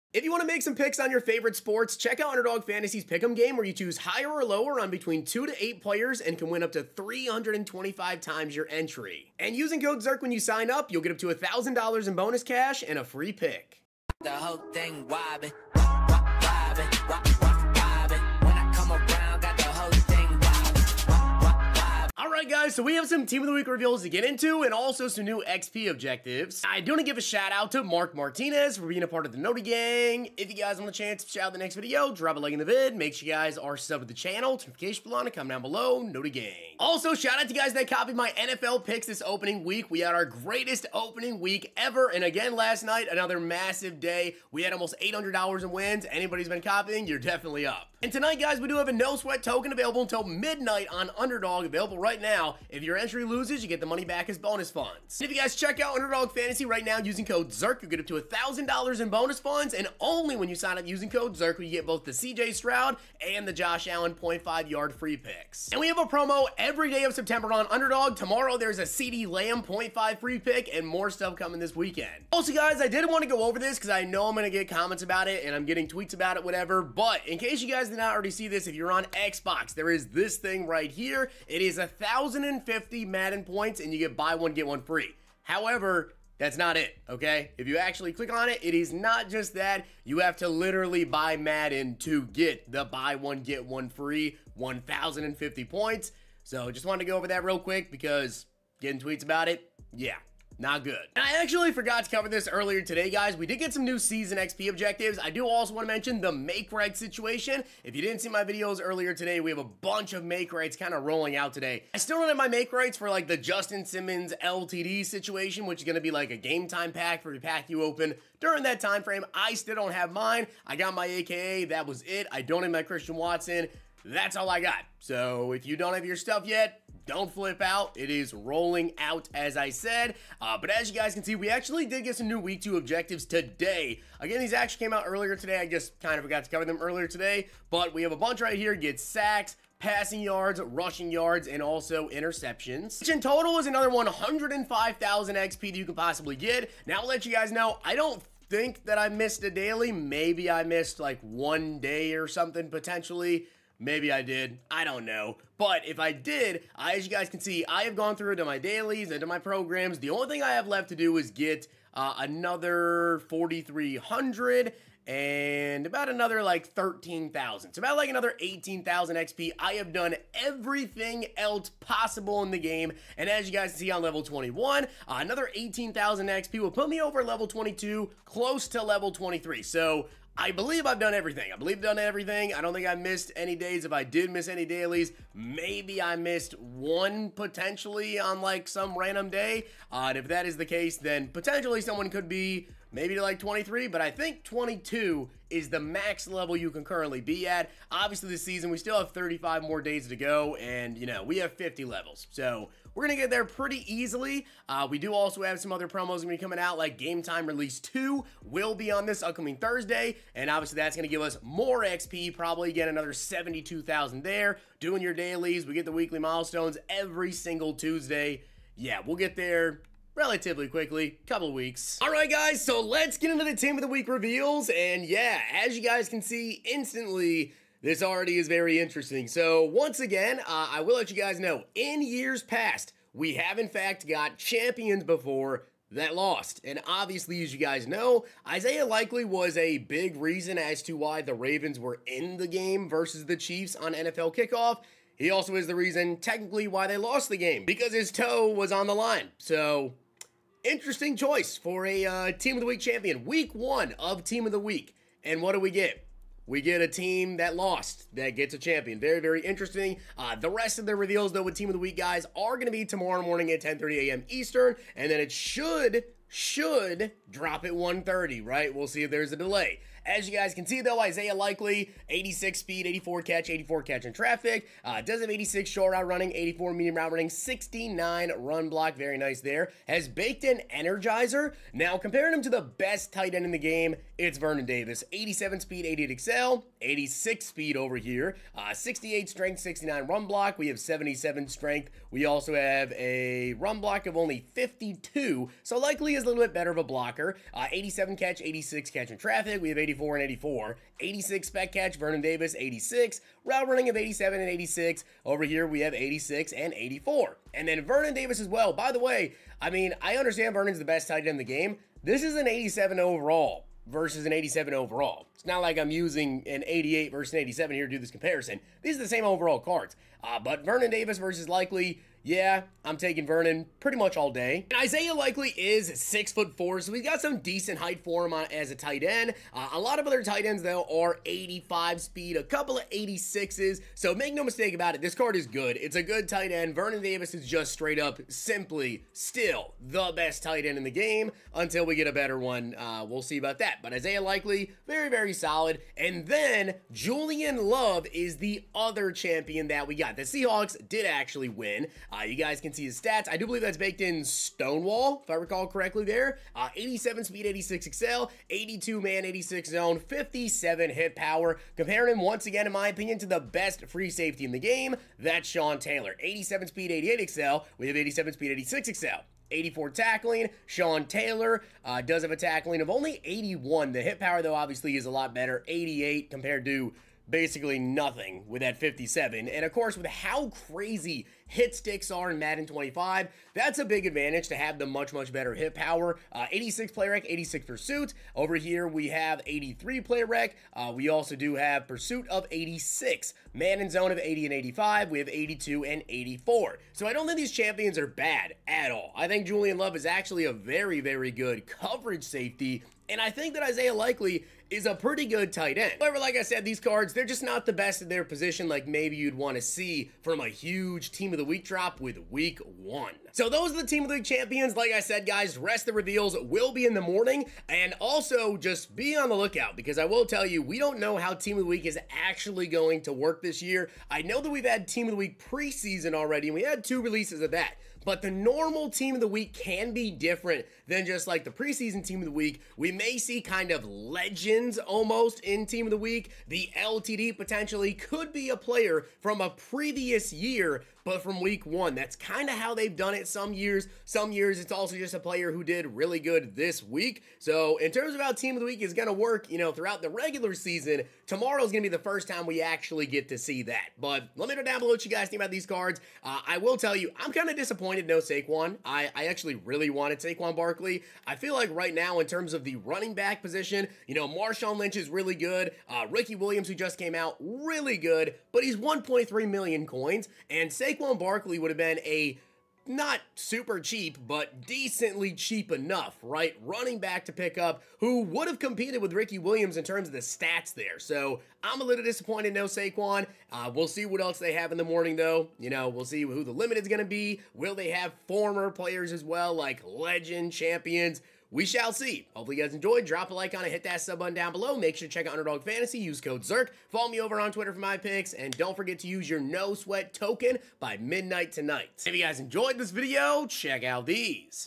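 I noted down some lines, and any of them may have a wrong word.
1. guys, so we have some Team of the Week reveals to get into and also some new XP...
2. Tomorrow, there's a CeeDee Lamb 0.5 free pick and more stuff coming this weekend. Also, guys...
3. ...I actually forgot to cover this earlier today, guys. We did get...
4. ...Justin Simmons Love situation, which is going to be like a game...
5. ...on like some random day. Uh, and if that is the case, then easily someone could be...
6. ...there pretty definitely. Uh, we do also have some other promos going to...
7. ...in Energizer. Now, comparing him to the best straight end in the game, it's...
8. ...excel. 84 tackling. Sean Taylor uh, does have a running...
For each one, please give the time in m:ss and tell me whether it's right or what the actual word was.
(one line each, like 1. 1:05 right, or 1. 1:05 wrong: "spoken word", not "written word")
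1. 0:22 right
2. 1:08 right
3. 1:41 right
4. 1:53 wrong: "LTD", not "Love"
5. 3:08 wrong: "potentially", not "easily"
6. 3:23 wrong: "easily", not "definitely"
7. 4:40 wrong: "tight", not "straight"
8. 6:08 wrong: "tackling", not "running".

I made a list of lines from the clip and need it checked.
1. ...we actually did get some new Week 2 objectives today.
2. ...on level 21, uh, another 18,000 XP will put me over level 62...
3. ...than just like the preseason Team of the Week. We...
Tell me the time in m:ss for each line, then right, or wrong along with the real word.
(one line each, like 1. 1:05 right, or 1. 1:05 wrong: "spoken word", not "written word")
1. 2:11 right
2. 2:53 wrong: "22", not "62"
3. 7:10 right.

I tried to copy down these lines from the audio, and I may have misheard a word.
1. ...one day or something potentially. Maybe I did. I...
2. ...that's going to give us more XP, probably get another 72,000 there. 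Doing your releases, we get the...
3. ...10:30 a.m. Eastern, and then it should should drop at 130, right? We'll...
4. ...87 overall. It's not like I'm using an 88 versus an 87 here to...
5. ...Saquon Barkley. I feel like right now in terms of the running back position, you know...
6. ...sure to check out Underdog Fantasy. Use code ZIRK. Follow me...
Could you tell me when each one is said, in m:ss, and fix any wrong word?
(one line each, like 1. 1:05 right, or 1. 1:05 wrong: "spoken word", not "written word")
1. 2:31 right
2. 3:30 wrong: "dailies", not "releases"
3. 4:23 right
4. 5:14 right
5. 7:40 right
6. 8:14 right.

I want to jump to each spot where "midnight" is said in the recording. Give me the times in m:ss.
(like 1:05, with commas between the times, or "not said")
0:50, 8:20.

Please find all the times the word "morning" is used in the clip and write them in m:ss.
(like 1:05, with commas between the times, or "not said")
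4:23, 6:57, 8:04.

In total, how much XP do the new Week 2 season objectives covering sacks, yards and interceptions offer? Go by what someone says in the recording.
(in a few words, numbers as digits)
105,000 XP.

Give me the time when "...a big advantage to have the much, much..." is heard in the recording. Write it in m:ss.
6:23.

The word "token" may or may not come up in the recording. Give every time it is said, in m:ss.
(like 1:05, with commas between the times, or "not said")
0:49, 8:20.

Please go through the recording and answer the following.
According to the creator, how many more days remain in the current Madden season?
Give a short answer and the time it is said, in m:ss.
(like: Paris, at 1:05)
35, at 3:19.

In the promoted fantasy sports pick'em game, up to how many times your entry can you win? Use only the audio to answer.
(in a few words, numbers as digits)
325.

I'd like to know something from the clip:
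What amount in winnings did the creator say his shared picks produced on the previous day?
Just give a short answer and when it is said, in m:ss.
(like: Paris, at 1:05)
Almost $800, at 0:44.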